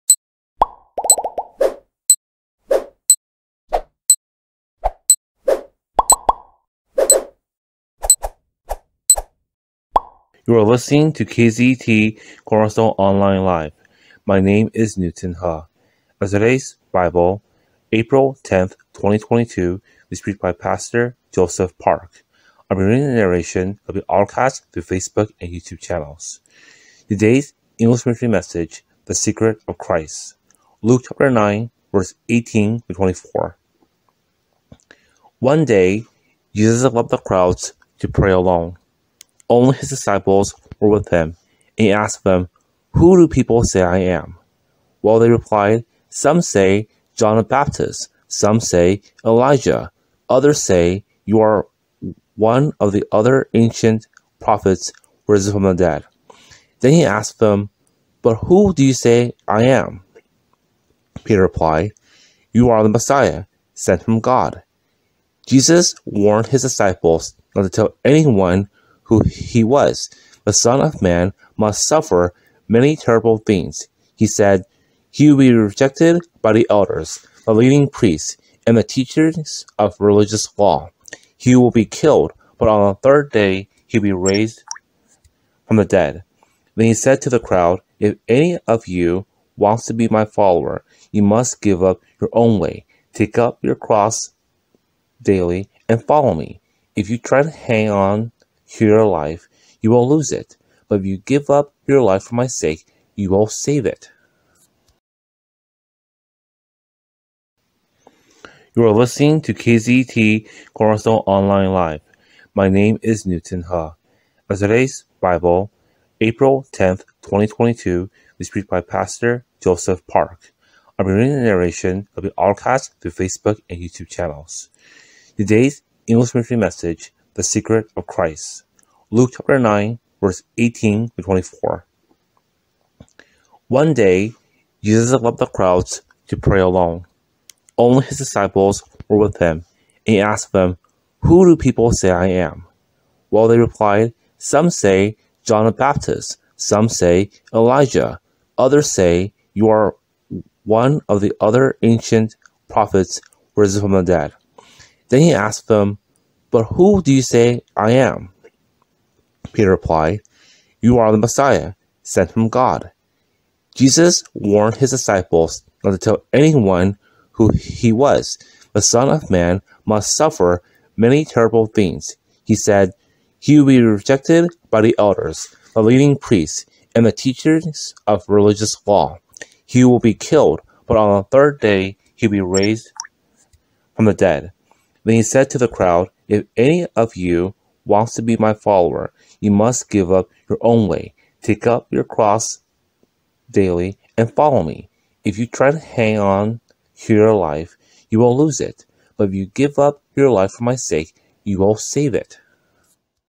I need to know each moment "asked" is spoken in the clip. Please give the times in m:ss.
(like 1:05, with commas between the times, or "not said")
0:41, 0:57, 2:20, 2:35.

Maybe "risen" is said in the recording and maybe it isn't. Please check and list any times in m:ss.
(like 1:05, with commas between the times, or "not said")
0:55, 2:33.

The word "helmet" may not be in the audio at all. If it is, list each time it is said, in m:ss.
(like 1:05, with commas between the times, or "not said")
not said.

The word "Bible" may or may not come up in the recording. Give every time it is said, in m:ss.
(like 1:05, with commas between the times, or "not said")
0:16, 1:55.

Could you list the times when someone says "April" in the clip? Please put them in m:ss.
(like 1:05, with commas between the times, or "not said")
0:17, 1:56.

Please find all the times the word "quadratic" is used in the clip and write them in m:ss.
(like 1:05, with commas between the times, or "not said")
not said.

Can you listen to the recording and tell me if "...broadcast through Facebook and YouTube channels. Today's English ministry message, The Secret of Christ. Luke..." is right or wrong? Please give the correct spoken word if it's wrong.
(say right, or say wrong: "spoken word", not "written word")
right.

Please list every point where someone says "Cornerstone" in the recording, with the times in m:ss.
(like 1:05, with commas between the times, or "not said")
0:12, 1:50.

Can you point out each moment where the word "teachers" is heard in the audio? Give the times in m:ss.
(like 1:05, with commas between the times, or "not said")
1:18, 2:57.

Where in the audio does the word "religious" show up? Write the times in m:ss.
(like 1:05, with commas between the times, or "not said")
1:19, 2:58.